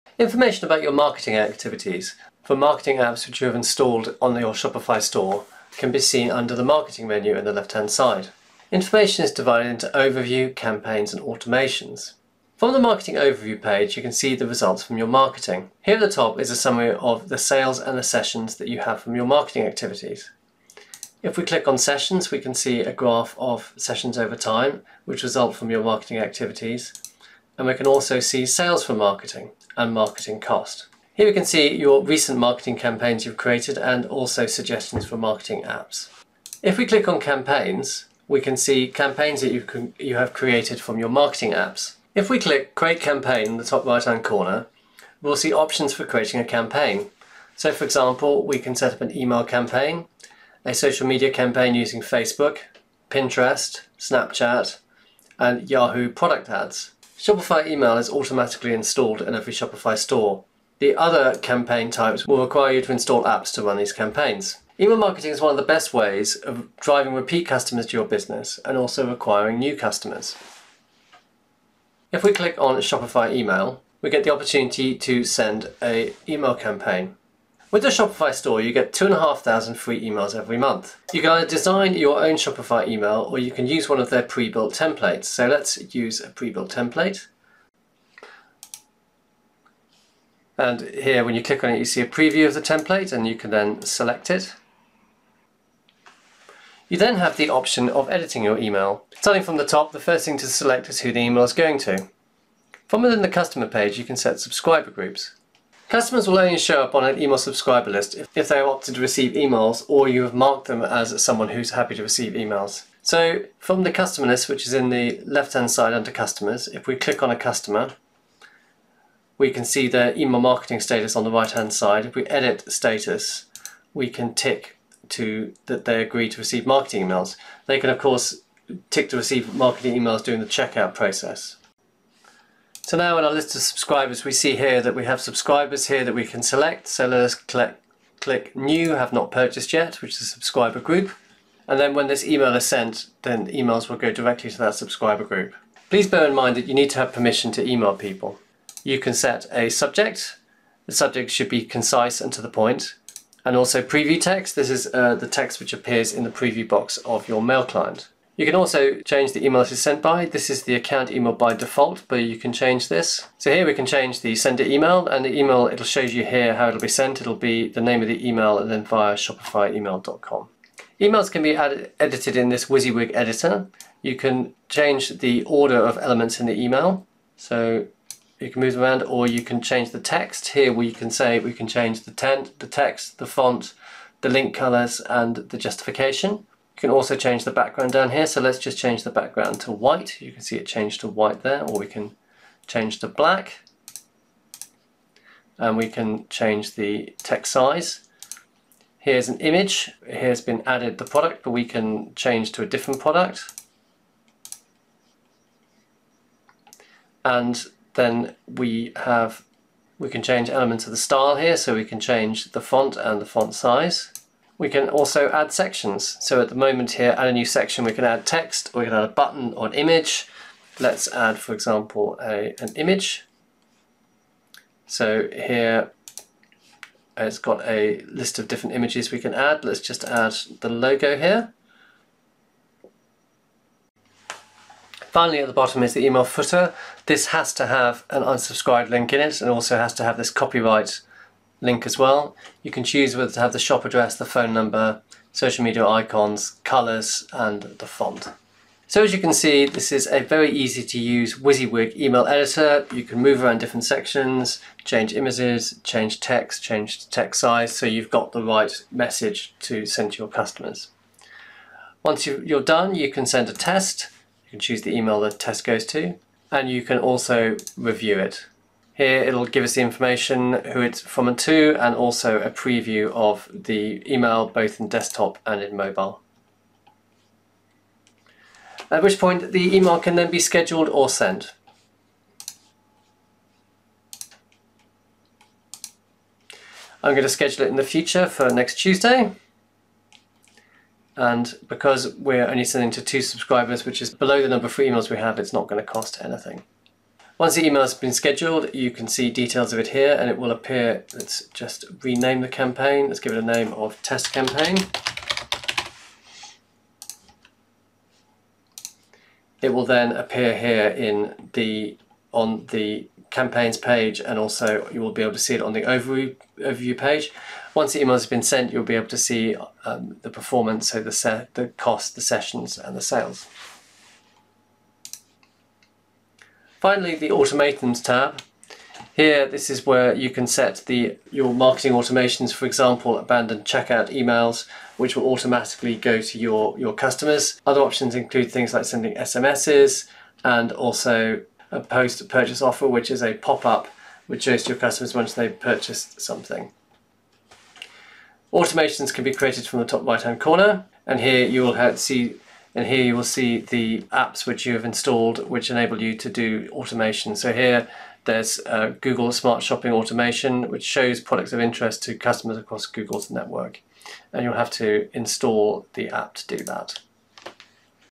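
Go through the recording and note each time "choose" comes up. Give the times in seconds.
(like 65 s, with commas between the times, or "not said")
242 s, 264 s.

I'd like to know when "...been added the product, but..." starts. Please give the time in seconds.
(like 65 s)
200 s.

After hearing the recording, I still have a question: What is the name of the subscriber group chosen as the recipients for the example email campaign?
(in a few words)
Have not purchased yet.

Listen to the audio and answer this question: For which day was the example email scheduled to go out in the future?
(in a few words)
Next Tuesday.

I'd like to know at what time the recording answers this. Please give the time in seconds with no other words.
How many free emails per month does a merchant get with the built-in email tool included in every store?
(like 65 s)
78 s.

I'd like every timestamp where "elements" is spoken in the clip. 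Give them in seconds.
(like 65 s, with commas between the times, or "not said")
175 s, 210 s.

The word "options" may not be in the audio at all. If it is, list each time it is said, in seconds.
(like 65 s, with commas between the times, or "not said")
45 s, 97 s, 337 s.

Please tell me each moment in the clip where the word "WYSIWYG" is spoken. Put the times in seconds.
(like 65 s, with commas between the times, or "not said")
172 s, 251 s.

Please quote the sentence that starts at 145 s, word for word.
Please bear in mind that you need to have permission to email people.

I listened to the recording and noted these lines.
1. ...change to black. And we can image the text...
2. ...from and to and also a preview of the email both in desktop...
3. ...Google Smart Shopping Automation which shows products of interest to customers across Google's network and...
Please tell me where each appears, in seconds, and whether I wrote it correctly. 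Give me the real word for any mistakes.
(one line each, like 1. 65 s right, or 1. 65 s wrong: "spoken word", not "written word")
1. 192 s wrong: "change", not "image"
2. 271 s right
3. 359 s right.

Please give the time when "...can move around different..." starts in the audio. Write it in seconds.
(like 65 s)
253 s.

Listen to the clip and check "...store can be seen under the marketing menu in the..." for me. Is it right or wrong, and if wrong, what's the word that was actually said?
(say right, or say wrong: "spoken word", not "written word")
right.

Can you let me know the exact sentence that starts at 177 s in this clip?
So you can move them around or you can change the text.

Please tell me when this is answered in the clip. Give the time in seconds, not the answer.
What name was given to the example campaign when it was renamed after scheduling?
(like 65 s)
304 s.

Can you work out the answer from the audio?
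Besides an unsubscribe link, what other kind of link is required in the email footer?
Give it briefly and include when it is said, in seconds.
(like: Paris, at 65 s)
Copyright link, at 240 s.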